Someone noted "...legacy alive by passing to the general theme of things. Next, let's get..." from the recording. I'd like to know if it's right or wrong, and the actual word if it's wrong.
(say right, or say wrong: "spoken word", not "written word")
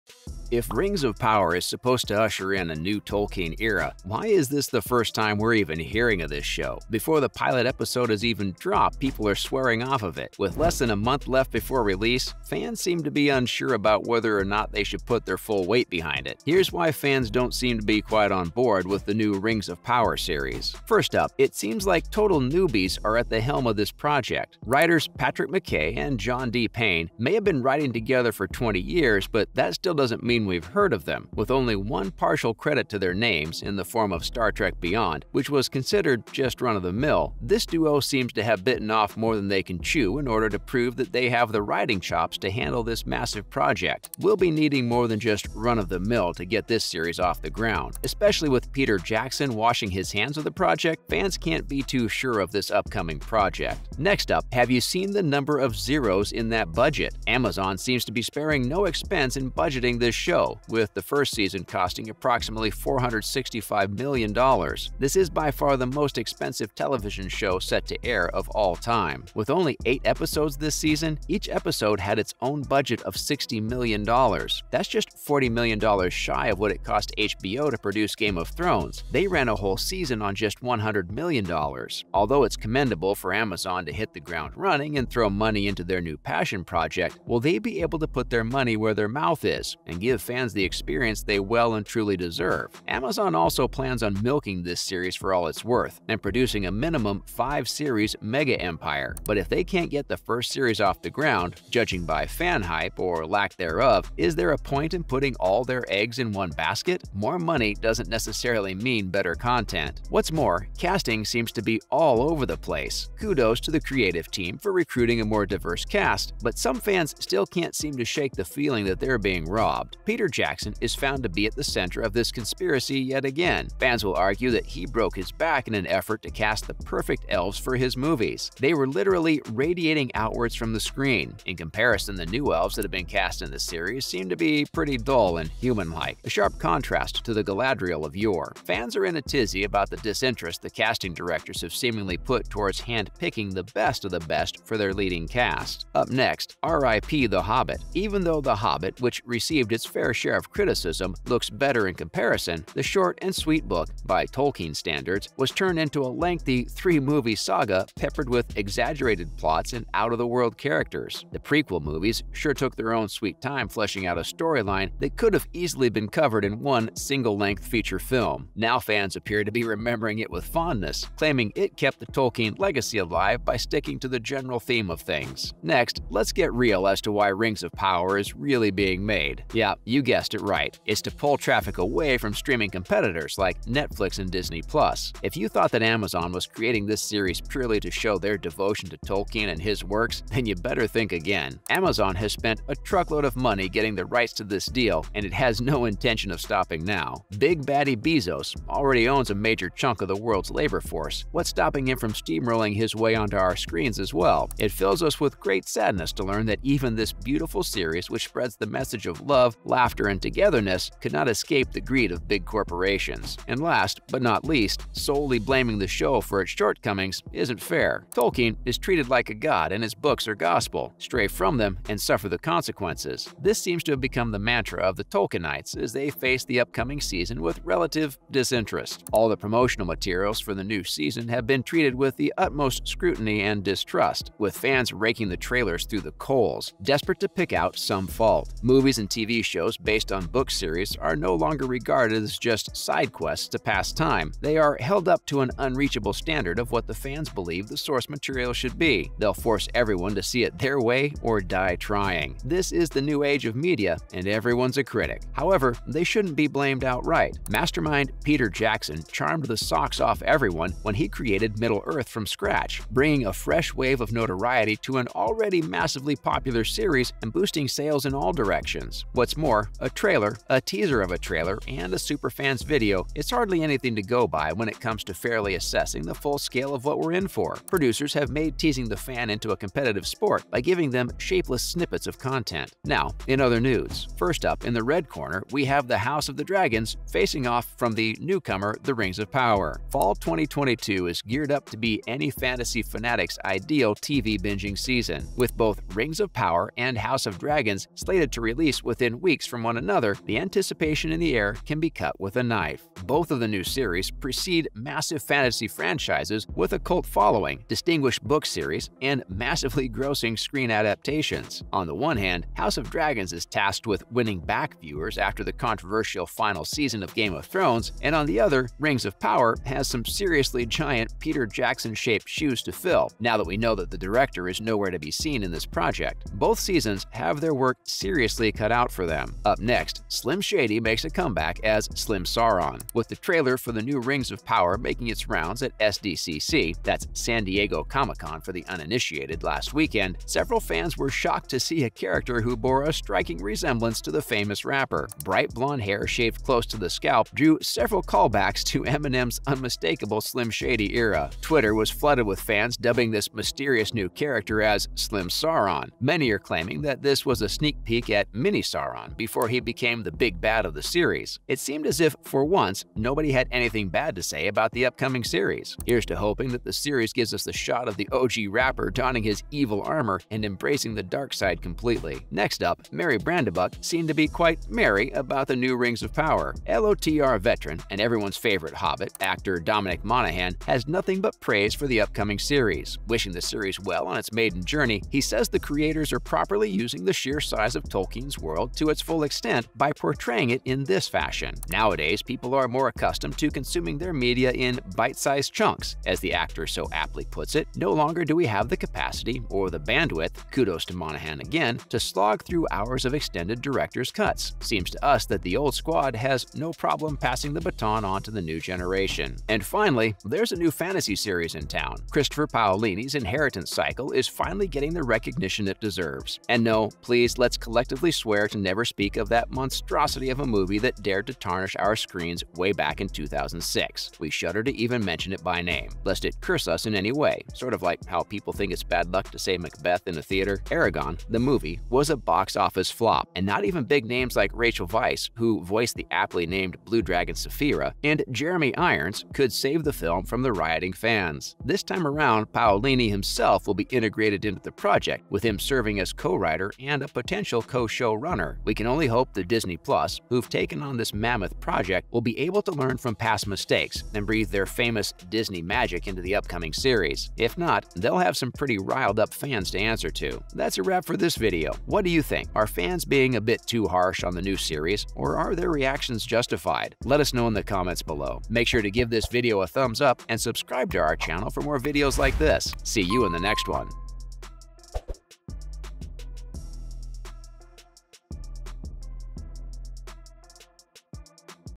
wrong: "sticking", not "passing".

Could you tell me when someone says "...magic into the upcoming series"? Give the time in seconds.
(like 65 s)
455 s.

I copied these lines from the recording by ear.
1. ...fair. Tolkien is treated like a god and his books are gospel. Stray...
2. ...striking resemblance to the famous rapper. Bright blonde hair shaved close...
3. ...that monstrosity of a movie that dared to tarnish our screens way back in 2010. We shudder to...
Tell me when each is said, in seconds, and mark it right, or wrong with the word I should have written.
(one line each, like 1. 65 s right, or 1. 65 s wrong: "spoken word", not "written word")
1. 217 s right
2. 342 s right
3. 419 s wrong: "2006", not "2010".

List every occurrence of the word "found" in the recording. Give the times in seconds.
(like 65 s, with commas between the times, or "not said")
120 s.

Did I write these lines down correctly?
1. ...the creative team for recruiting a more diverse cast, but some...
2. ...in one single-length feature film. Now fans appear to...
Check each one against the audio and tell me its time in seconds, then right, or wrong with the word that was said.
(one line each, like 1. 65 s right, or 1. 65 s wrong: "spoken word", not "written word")
1. 113 s right
2. 166 s right.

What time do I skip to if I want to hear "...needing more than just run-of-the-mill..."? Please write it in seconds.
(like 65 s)
44 s.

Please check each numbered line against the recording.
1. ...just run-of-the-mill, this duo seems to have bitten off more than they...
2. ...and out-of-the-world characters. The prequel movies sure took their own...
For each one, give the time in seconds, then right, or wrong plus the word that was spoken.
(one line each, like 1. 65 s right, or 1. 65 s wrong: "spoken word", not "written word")
1. 36 s right
2. 159 s right.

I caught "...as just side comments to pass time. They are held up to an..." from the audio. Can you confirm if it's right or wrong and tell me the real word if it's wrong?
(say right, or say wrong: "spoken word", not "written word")
wrong: "quests", not "comments".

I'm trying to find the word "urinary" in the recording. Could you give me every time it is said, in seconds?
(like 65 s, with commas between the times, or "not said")
not said.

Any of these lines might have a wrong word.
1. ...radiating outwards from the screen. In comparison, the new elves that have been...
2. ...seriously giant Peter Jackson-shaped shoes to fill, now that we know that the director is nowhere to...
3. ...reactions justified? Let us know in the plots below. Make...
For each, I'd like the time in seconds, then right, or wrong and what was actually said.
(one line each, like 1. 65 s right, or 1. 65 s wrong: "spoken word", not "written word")
1. 129 s right
2. 320 s right
3. 465 s wrong: "comments", not "plots".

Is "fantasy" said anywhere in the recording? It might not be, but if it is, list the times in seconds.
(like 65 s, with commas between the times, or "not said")
292 s, 305 s, 410 s.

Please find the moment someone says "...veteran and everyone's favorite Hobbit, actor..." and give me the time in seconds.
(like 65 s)
377 s.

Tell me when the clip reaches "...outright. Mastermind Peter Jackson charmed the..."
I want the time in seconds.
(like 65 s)
256 s.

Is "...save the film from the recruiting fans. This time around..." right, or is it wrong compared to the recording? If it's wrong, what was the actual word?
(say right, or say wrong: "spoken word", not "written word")
wrong: "rioting", not "recruiting".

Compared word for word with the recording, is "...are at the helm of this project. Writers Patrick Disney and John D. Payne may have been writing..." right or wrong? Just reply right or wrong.
wrong.